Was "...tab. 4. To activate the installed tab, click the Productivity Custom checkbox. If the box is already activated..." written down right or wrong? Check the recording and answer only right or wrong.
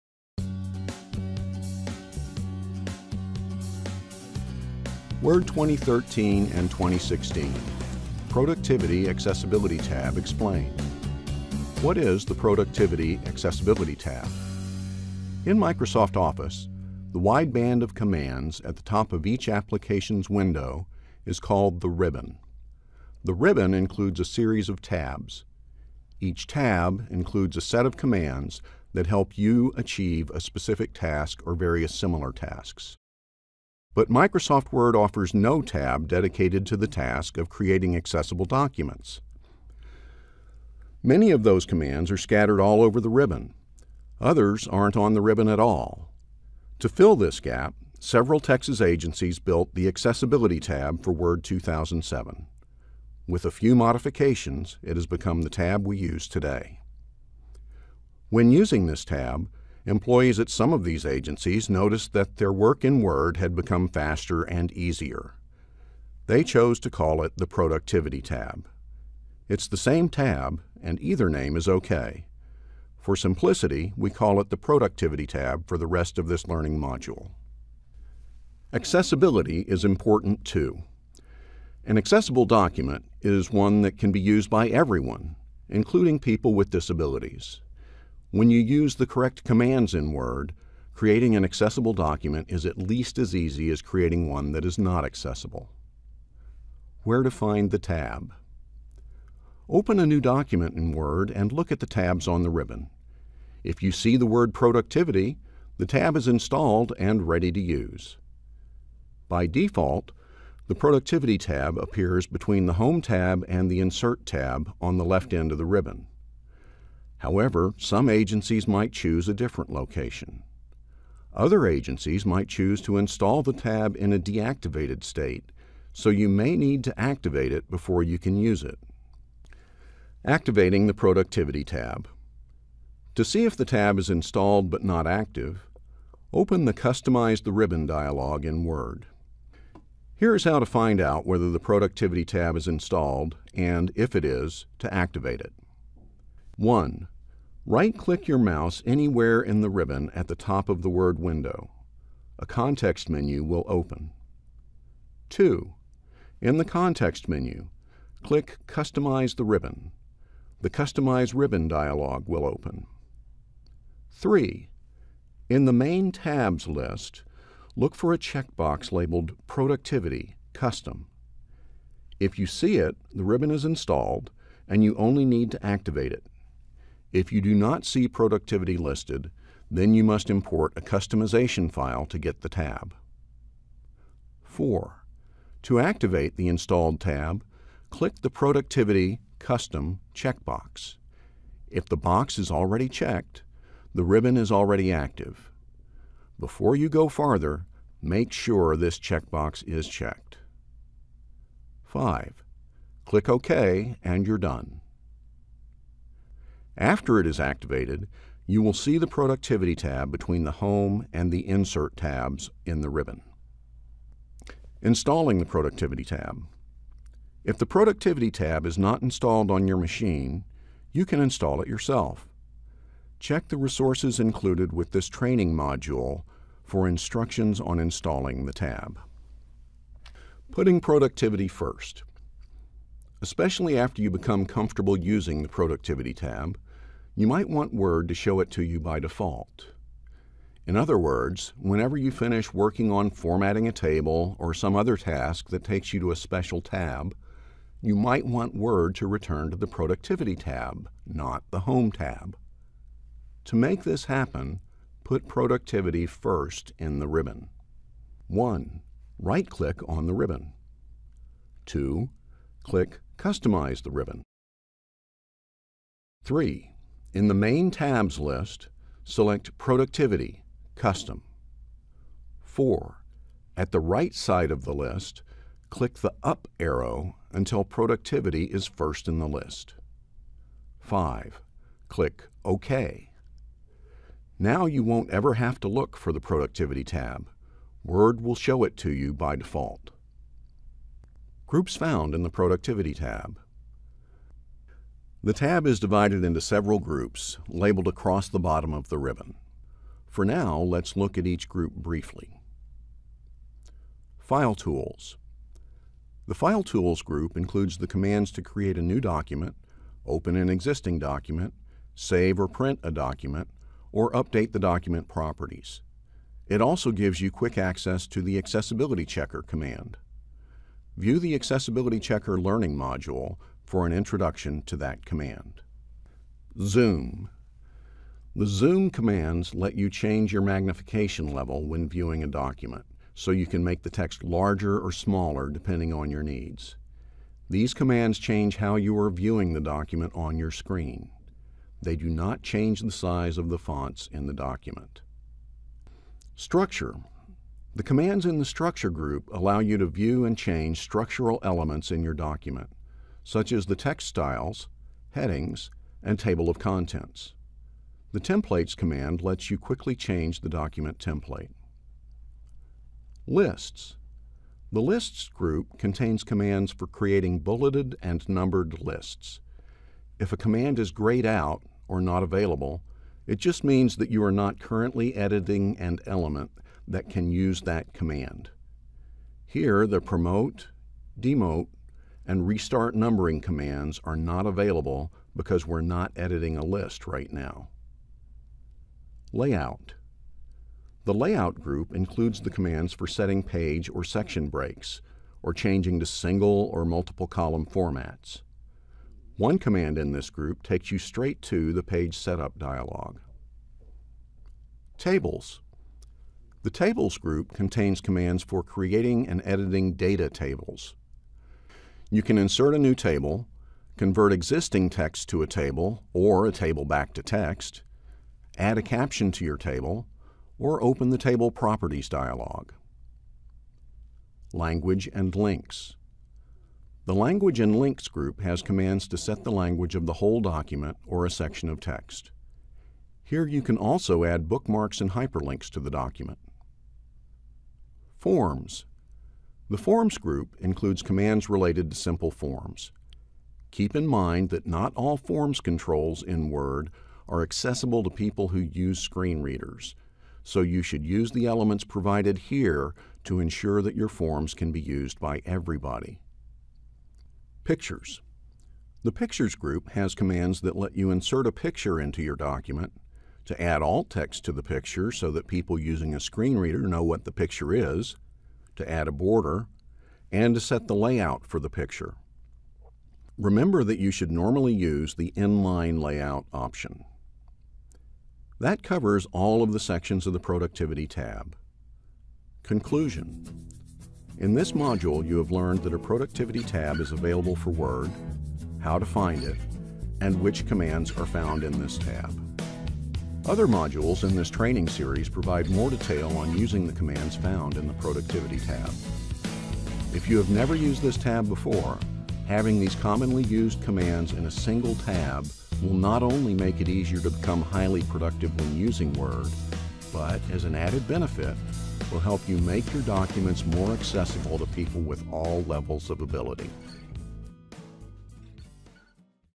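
wrong.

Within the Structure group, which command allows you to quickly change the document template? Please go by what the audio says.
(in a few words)
Templates.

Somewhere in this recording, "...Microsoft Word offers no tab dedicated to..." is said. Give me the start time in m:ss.
0:34.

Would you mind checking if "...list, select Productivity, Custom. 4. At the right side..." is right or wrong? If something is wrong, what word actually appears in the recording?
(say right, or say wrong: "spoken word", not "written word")
right.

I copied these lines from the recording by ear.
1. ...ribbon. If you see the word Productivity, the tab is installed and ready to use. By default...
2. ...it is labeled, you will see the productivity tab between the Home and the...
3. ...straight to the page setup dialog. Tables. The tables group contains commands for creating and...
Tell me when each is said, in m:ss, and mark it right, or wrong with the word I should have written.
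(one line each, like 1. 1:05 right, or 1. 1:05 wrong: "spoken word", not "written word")
1. 1:42 right
2. 3:27 wrong: "activated", not "labeled"
3. 6:40 right.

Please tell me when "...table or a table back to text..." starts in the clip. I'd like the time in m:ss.
6:55.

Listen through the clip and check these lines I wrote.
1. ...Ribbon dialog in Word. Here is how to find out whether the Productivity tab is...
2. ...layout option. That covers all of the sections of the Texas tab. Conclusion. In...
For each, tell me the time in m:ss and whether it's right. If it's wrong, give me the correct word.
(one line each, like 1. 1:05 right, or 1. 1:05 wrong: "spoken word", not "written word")
1. 2:17 right
2. 7:56 wrong: "Productivity", not "Texas".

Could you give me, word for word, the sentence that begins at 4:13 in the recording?
To make this happen, put Productivity first in the ribbon.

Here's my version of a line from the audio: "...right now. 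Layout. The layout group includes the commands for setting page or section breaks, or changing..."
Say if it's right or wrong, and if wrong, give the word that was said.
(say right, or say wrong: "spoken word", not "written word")
right.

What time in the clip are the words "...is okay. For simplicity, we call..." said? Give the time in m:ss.
1:11.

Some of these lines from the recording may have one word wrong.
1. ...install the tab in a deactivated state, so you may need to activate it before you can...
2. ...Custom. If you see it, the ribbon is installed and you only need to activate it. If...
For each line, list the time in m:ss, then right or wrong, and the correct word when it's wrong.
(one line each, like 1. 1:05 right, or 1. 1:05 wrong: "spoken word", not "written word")
1. 2:02 right
2. 2:50 right.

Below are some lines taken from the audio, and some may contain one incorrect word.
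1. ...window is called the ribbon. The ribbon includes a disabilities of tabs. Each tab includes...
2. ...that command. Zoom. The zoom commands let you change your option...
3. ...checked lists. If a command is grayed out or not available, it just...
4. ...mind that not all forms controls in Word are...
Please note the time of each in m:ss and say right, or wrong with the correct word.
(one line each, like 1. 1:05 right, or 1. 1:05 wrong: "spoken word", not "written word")
1. 0:20 wrong: "series", not "disabilities"
2. 5:24 wrong: "magnification", not "option"
3. 6:08 wrong: "numbered", not "checked"
4. 7:24 right.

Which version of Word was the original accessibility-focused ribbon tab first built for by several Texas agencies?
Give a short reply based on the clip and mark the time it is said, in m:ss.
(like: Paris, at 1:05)
Word 2007, at 0:51.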